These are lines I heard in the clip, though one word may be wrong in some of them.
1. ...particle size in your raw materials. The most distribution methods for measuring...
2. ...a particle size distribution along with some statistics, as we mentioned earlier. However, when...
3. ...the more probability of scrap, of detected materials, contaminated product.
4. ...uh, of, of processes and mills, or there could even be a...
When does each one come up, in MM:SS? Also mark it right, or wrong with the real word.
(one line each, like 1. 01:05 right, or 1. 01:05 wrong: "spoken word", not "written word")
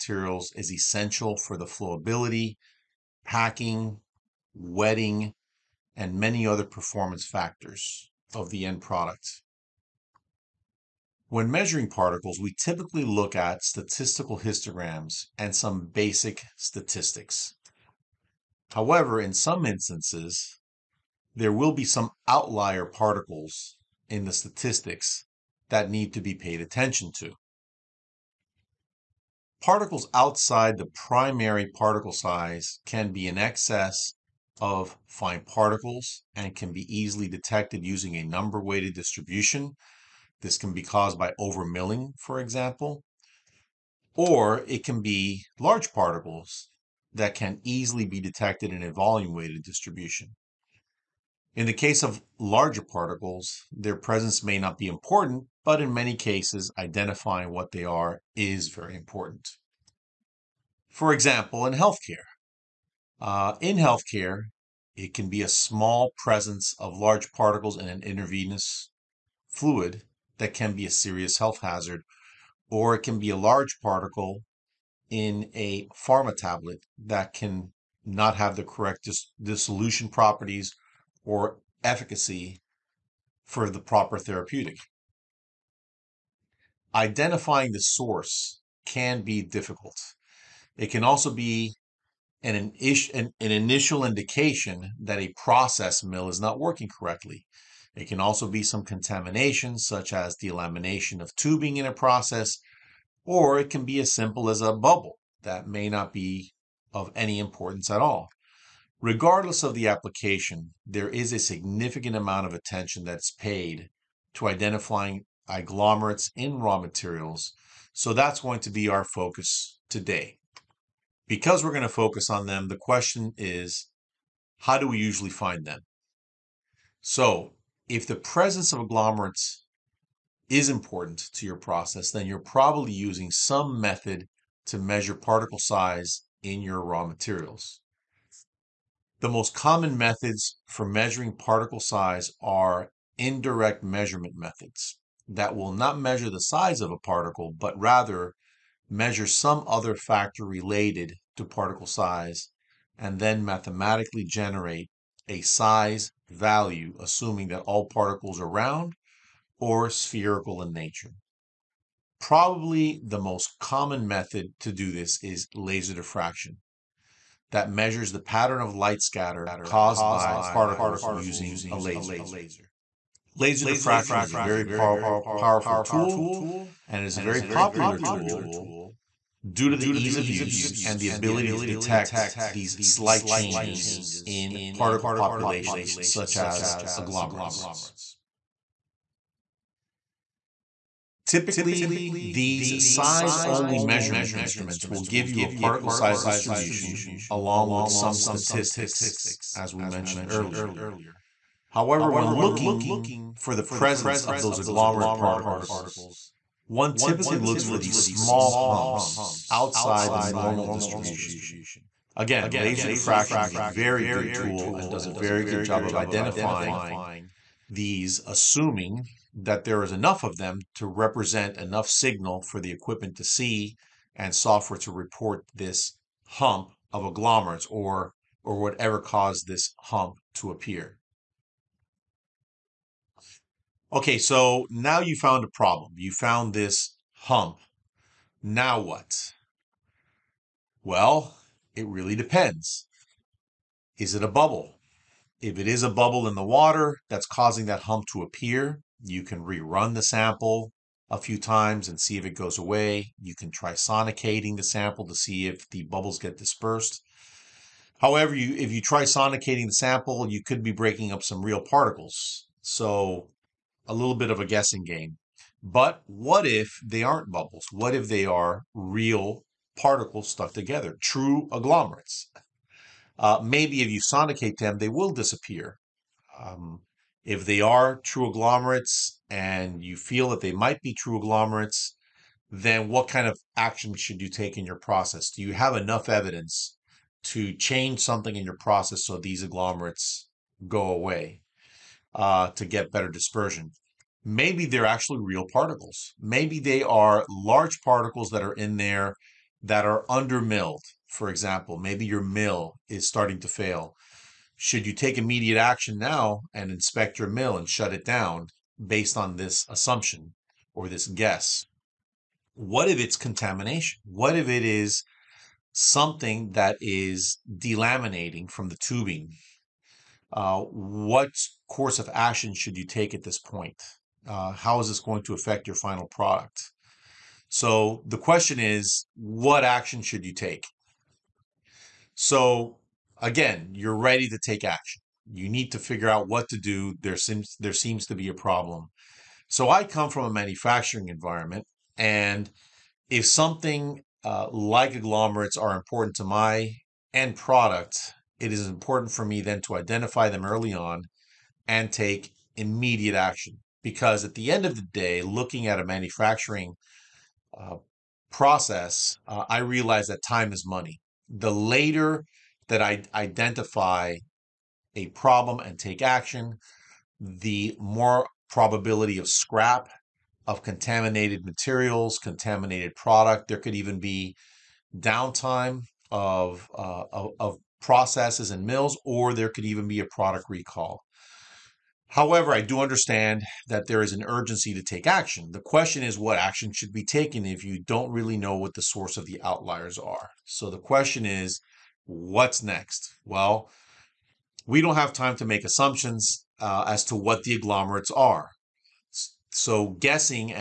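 1. 02:15 wrong: "common", not "distribution"
2. 03:15 right
3. 06:07 wrong: "contaminated", not "detected"
4. 06:16 right.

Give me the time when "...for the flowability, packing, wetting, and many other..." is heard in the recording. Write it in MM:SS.
00:01.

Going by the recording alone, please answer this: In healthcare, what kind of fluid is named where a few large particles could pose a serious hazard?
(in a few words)
intravenous fluid.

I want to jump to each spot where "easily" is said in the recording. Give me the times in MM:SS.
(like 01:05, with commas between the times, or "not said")
00:36, 00:47.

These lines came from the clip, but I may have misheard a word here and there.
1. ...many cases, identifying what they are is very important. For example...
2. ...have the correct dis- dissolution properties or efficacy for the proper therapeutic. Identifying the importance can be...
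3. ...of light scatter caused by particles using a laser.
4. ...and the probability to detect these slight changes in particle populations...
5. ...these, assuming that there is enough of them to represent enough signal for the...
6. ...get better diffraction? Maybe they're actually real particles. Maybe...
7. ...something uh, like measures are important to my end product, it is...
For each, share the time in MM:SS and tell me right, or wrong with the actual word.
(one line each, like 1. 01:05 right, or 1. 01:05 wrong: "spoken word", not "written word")
1. 00:55 right
2. 01:18 wrong: "source", not "importance"
3. 02:48 right
4. 03:00 wrong: "ability", not "probability"
5. 03:37 right
6. 04:52 wrong: "dispersion", not "diffraction"
7. 05:43 wrong: "agglomerates", not "measures".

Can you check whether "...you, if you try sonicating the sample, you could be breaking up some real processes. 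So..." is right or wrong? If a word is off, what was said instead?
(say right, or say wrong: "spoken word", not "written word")
wrong: "particles", not "processes".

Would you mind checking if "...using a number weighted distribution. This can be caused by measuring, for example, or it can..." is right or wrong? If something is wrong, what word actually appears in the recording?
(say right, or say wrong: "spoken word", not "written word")
wrong: "overmilling", not "measuring".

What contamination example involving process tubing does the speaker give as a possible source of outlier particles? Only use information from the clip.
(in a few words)
delamination of tubing.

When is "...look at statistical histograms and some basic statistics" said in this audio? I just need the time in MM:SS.
00:13.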